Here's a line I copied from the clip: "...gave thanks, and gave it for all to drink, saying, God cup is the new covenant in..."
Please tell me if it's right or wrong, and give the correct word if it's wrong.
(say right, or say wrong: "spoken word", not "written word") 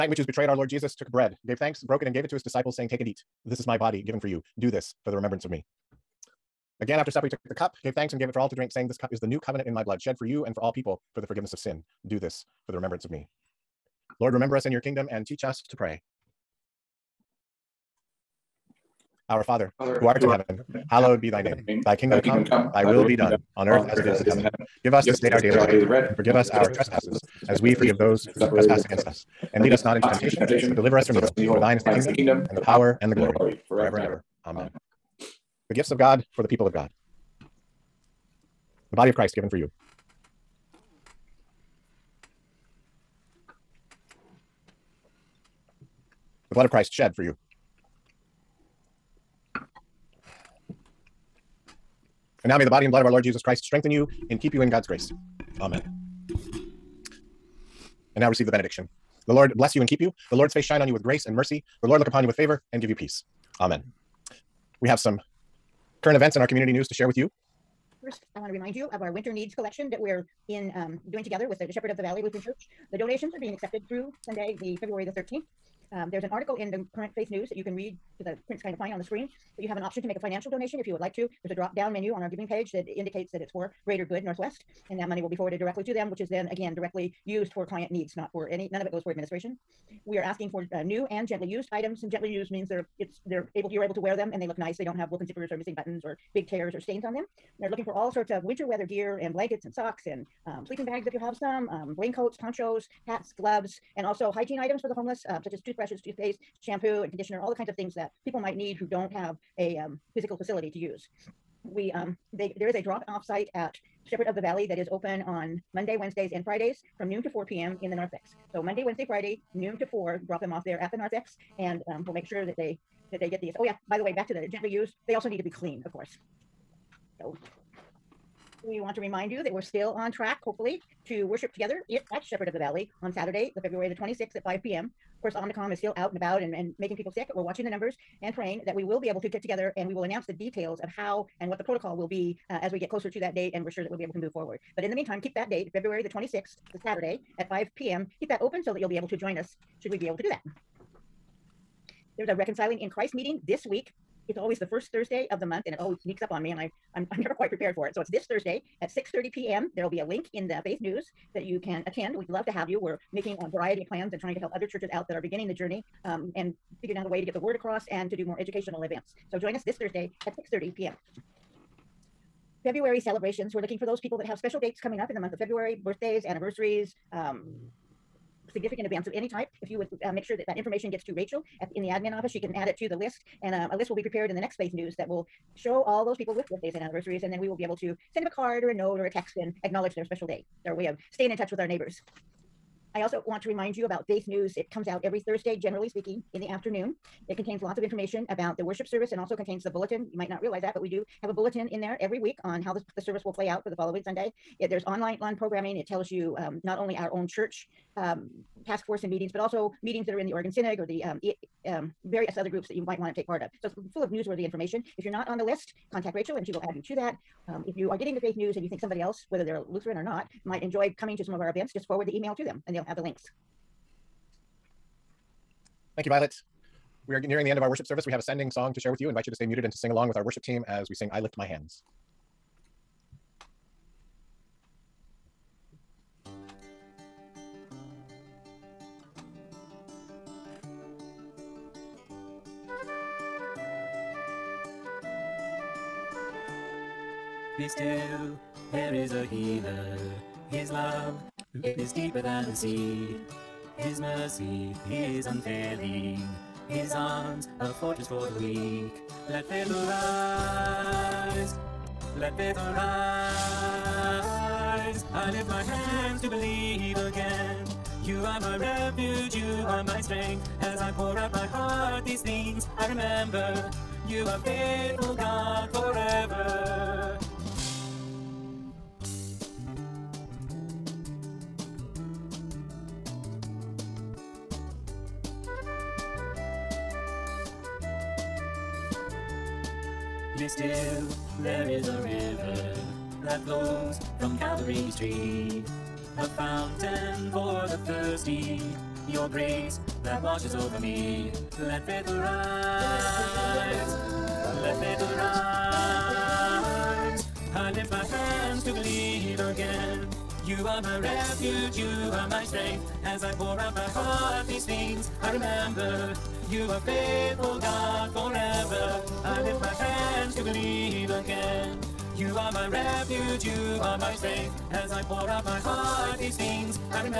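wrong: "This", not "God".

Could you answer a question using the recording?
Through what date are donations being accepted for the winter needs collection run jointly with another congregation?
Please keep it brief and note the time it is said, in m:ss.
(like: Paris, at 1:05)
February 13, at 1:14.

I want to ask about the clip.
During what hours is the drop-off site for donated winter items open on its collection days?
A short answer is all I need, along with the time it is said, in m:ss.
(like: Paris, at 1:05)
noon to 4 p.m., at 1:57.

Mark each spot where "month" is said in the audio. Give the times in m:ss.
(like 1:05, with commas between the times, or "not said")
2:35, 2:55.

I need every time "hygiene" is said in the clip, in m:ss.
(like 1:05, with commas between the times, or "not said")
1:44.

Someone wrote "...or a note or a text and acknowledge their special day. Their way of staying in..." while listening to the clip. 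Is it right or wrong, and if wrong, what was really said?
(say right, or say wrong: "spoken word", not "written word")
right.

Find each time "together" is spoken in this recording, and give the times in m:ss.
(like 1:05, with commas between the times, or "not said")
1:11, 2:11, 2:19.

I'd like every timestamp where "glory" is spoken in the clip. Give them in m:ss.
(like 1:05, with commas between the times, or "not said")
0:33.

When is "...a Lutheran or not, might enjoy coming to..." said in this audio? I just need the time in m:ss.
3:39.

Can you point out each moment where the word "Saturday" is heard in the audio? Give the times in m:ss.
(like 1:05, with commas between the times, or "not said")
2:13, 2:26.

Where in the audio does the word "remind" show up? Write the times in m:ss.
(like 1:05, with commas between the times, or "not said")
1:08, 2:08, 3:13.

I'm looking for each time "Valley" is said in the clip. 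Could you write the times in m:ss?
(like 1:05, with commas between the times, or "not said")
1:12, 1:54, 2:12.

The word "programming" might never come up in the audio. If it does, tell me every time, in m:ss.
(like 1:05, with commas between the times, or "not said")
3:25.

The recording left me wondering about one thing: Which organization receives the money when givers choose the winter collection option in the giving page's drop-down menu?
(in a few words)
Greater Good Northwest.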